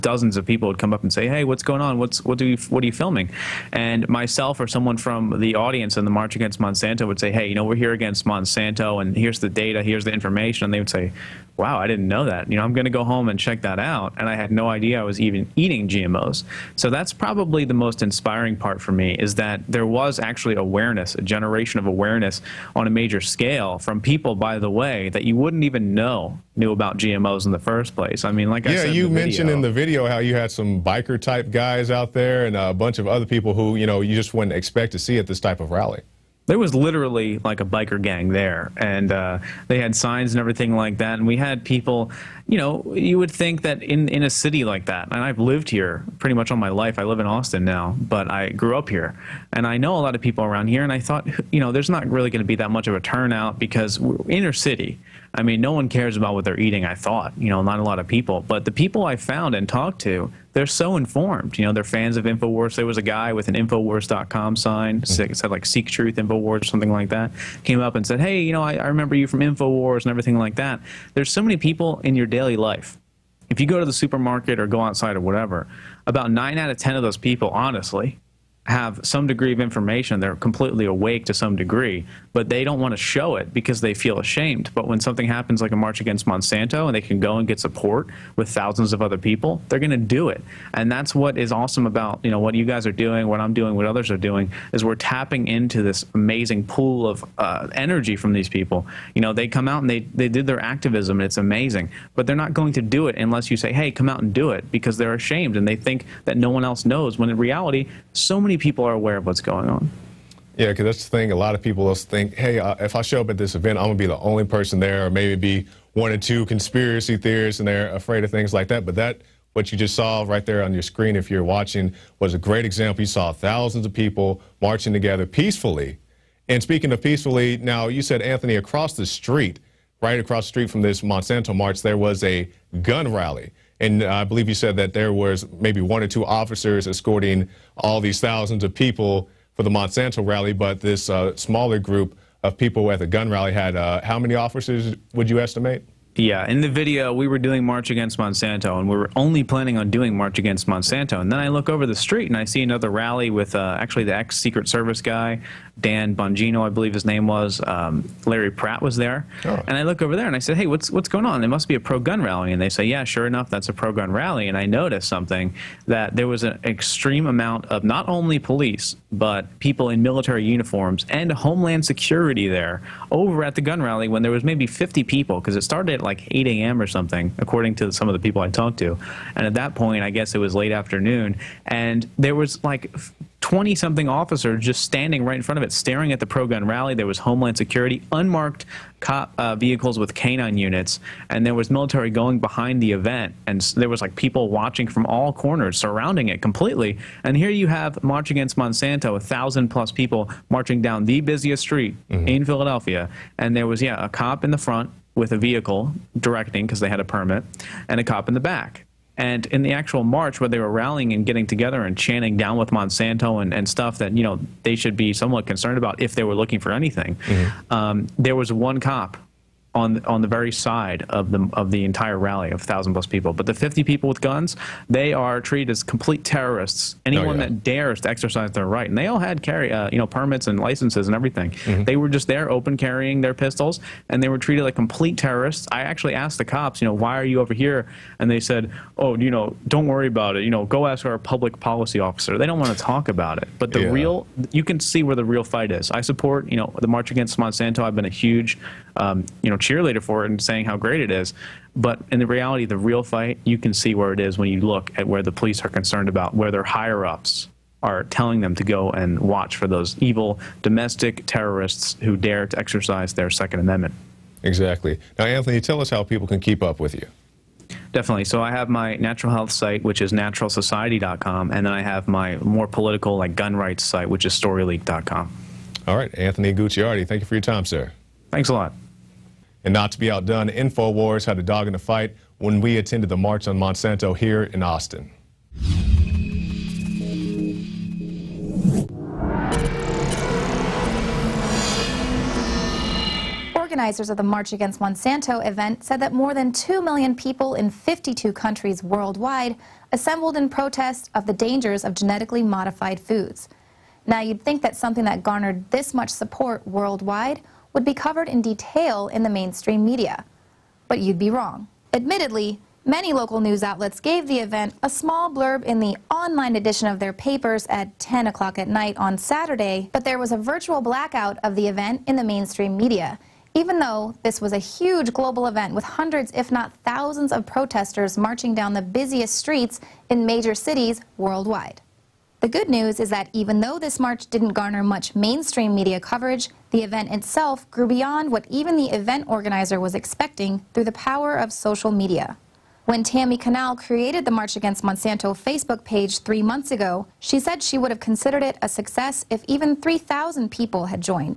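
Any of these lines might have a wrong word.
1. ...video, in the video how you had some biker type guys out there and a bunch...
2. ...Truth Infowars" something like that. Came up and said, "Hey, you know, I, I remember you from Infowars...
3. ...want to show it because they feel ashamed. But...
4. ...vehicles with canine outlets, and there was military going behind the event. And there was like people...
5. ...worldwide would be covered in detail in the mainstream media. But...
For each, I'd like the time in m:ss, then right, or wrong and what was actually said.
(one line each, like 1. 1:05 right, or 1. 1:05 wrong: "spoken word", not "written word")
1. 0:29 right
2. 1:05 right
3. 1:22 right
4. 3:09 wrong: "units", not "outlets"
5. 5:06 right.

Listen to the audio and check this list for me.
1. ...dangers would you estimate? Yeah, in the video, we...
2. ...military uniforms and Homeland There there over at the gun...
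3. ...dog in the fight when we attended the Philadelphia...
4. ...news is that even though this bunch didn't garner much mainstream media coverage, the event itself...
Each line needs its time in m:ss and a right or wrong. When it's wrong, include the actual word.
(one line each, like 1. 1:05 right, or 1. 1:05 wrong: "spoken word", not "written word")
1. 2:24 wrong: "officers", not "dangers"
2. 2:50 wrong: "Security", not "There"
3. 4:41 wrong: "March", not "Philadelphia"
4. 5:32 wrong: "march", not "bunch".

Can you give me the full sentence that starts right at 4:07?
I've been a huge um, you know, cheerleader for it and saying how great it is.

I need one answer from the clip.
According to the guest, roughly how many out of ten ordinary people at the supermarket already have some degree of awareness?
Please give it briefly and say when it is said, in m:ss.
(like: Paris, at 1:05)
9, at 1:16.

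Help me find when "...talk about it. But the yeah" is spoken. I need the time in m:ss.
4:02.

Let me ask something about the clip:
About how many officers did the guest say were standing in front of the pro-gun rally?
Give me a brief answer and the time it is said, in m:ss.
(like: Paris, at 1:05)
20 something, at 3:03.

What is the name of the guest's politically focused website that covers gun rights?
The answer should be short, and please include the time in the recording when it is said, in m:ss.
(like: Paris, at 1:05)
storyleak.com, at 4:34.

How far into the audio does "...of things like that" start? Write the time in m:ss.
1:58.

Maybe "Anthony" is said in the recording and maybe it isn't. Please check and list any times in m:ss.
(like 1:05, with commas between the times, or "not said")
2:08, 4:25, 4:36.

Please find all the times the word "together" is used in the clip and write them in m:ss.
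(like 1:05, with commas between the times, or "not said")
2:04, 3:31.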